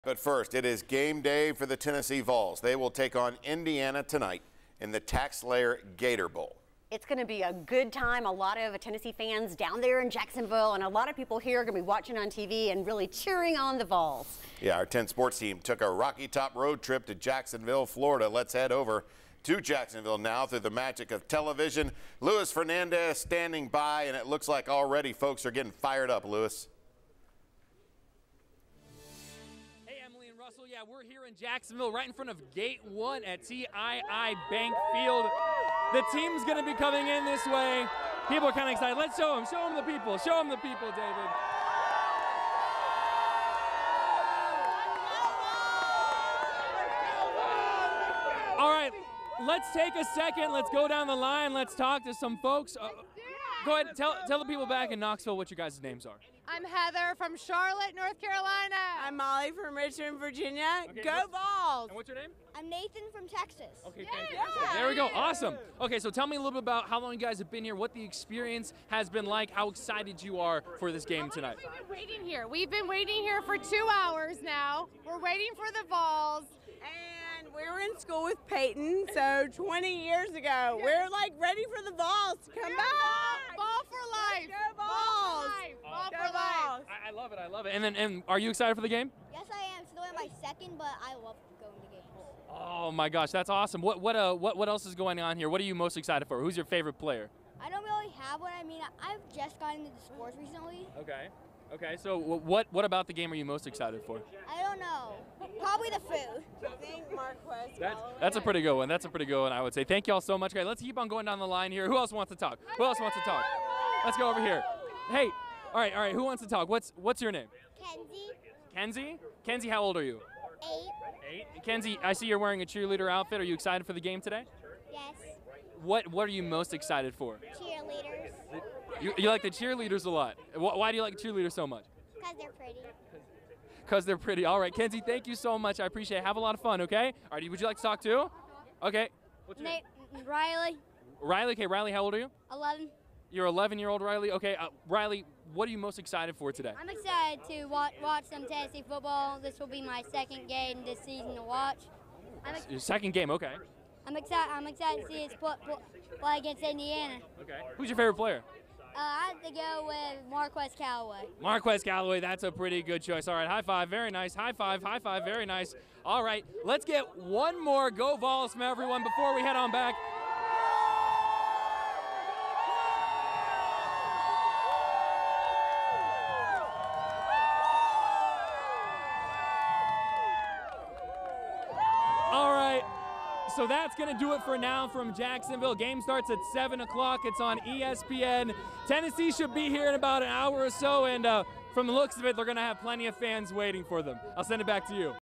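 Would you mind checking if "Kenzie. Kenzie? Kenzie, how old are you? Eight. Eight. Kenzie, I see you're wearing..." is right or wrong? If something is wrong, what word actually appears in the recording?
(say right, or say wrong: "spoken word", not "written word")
right.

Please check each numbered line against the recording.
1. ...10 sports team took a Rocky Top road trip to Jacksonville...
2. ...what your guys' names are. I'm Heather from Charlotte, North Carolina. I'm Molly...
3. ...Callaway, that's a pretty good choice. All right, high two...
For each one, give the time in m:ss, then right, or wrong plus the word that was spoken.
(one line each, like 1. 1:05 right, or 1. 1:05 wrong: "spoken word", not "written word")
1. 0:14 right
2. 0:55 right
3. 2:41 wrong: "five", not "two".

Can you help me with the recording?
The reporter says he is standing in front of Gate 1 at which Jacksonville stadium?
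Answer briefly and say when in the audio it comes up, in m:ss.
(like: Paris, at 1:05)
TIAA Bank Field, at 0:33.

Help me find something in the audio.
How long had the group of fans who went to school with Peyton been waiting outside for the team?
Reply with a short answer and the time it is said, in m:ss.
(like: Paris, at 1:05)
2 hours, at 1:13.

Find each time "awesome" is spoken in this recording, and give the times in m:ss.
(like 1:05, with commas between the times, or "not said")
1:05, 1:33.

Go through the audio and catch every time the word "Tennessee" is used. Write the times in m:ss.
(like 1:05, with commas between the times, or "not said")
0:01, 0:08, 2:28, 3:08.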